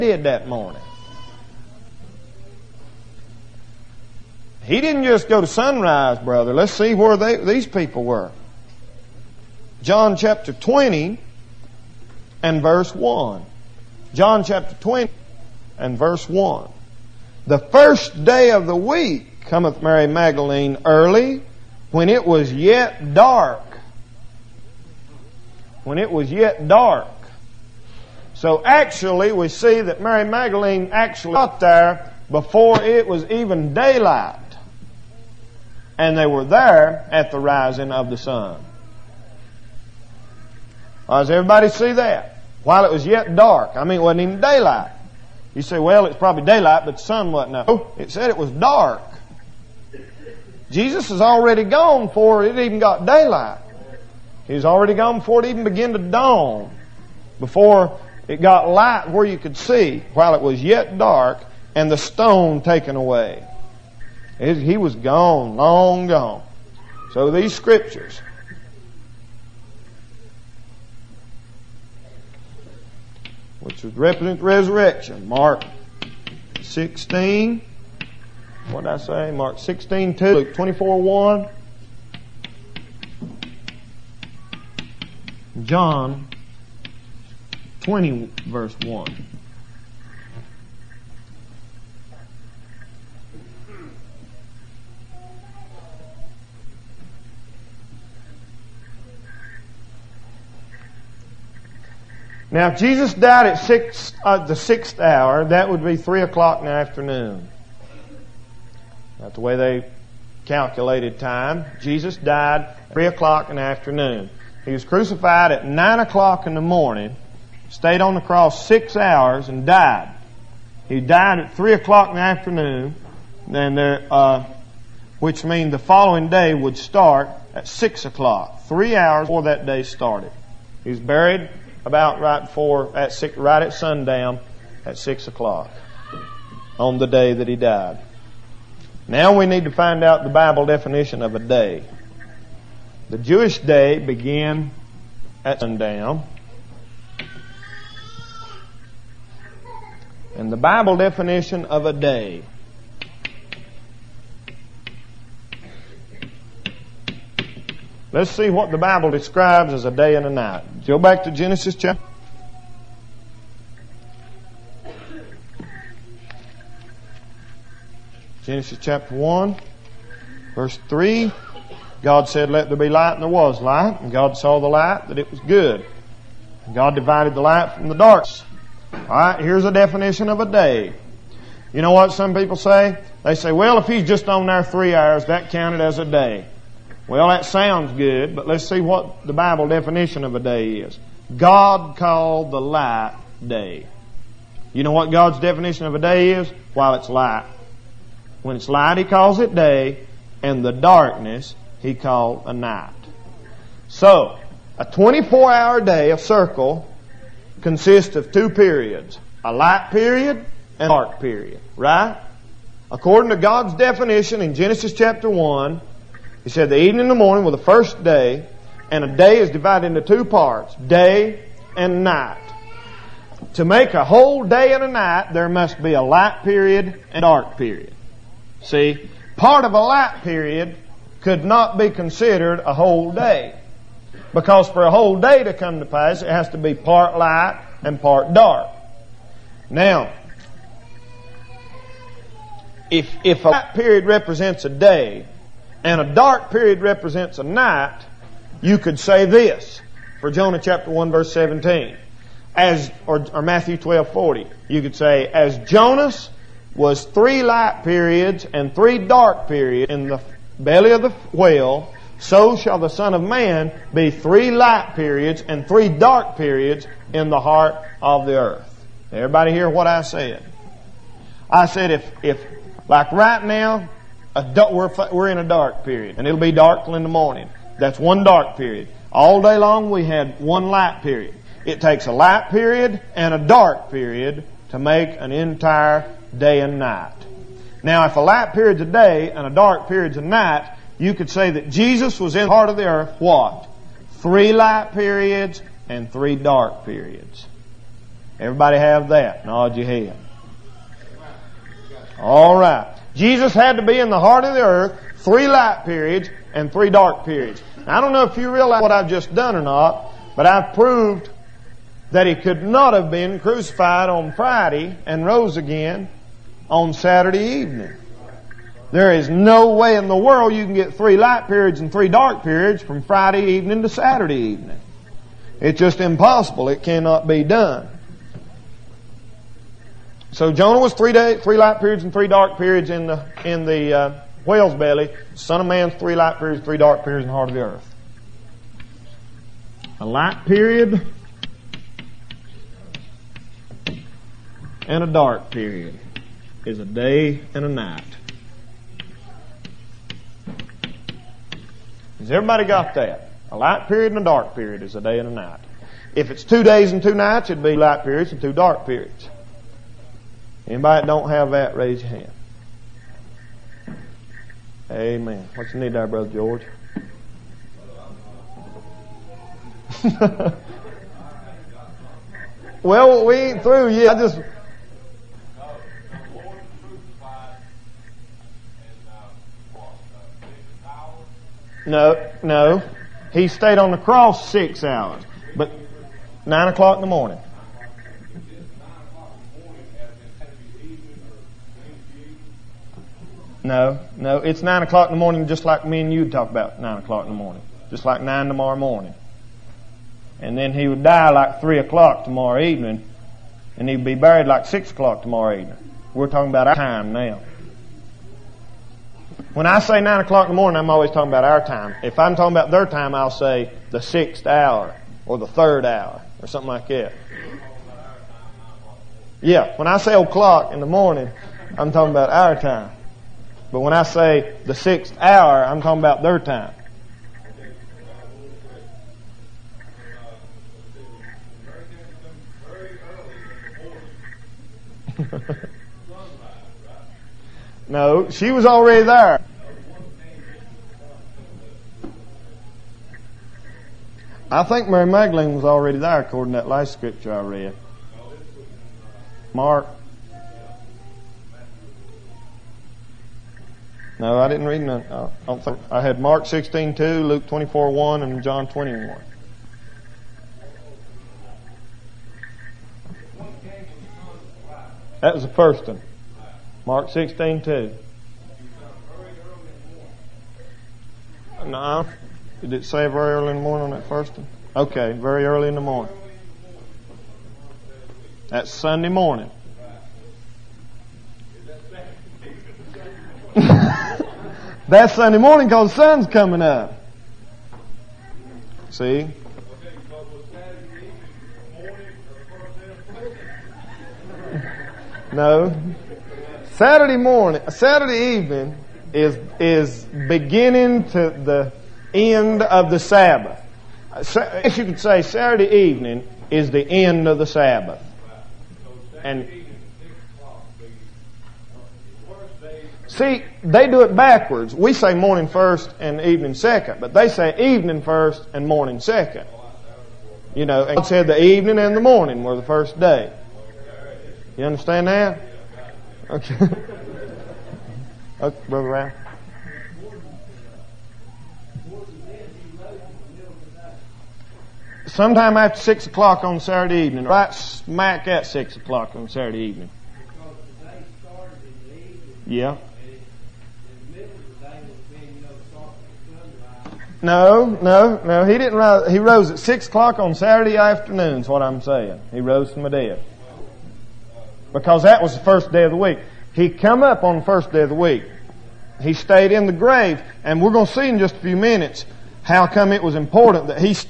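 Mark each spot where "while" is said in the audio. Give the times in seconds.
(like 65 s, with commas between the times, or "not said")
42 s, 60 s, 196 s.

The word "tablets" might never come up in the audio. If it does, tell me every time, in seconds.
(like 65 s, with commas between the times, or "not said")
not said.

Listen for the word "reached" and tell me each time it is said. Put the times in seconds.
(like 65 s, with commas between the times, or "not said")
not said.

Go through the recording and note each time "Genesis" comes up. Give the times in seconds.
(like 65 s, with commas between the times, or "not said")
161 s, 168 s, 214 s.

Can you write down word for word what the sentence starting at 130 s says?
He was buried about right before, at six, right at sundown at 6 o'clock on the day that he died.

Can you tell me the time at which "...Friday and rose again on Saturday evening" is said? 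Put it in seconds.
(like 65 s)
314 s.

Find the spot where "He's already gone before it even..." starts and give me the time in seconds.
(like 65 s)
54 s.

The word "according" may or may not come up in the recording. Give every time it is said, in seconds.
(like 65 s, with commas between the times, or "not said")
212 s, 446 s.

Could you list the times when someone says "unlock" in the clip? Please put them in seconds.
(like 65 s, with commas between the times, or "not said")
not said.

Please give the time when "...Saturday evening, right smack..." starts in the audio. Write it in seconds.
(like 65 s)
536 s.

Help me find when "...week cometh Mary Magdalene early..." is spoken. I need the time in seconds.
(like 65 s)
18 s.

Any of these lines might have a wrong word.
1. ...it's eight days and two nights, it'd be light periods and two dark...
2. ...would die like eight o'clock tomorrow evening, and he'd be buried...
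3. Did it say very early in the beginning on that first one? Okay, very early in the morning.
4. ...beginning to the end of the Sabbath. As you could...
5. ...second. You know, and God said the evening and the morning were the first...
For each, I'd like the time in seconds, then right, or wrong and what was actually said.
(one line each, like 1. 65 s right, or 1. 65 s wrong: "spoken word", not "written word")
1. 356 s wrong: "two", not "eight"
2. 400 s wrong: "three", not "eight"
3. 472 s wrong: "morning", not "beginning"
4. 500 s right
5. 519 s right.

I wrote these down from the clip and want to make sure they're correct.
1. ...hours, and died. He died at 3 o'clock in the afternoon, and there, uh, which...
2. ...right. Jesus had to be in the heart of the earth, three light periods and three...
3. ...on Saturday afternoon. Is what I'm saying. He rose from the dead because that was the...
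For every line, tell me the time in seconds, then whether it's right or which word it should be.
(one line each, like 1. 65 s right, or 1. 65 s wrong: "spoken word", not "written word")
1. 118 s right
2. 302 s right
3. 550 s right.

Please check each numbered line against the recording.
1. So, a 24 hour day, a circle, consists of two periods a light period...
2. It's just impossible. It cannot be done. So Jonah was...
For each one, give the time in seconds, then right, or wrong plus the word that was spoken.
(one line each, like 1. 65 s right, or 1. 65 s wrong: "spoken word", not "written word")
1. 203 s right
2. 325 s right.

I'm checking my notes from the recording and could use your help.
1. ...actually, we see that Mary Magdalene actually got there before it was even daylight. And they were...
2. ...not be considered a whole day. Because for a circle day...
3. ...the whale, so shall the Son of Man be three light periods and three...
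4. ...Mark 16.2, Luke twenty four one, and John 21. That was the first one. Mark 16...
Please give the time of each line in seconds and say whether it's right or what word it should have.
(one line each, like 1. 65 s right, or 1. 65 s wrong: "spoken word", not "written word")
1. 28 s right
2. 231 s wrong: "whole", not "circle"
3. 261 s right
4. 456 s right.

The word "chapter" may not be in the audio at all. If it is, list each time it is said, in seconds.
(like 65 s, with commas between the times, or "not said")
10 s, 14 s, 161 s, 168 s, 214 s, 250 s.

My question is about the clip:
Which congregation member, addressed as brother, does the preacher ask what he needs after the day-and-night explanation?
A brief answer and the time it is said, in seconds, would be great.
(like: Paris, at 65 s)
Brother George, at 366 s.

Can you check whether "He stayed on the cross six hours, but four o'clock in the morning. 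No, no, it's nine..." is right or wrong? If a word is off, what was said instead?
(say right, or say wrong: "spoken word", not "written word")
wrong: "nine", not "four".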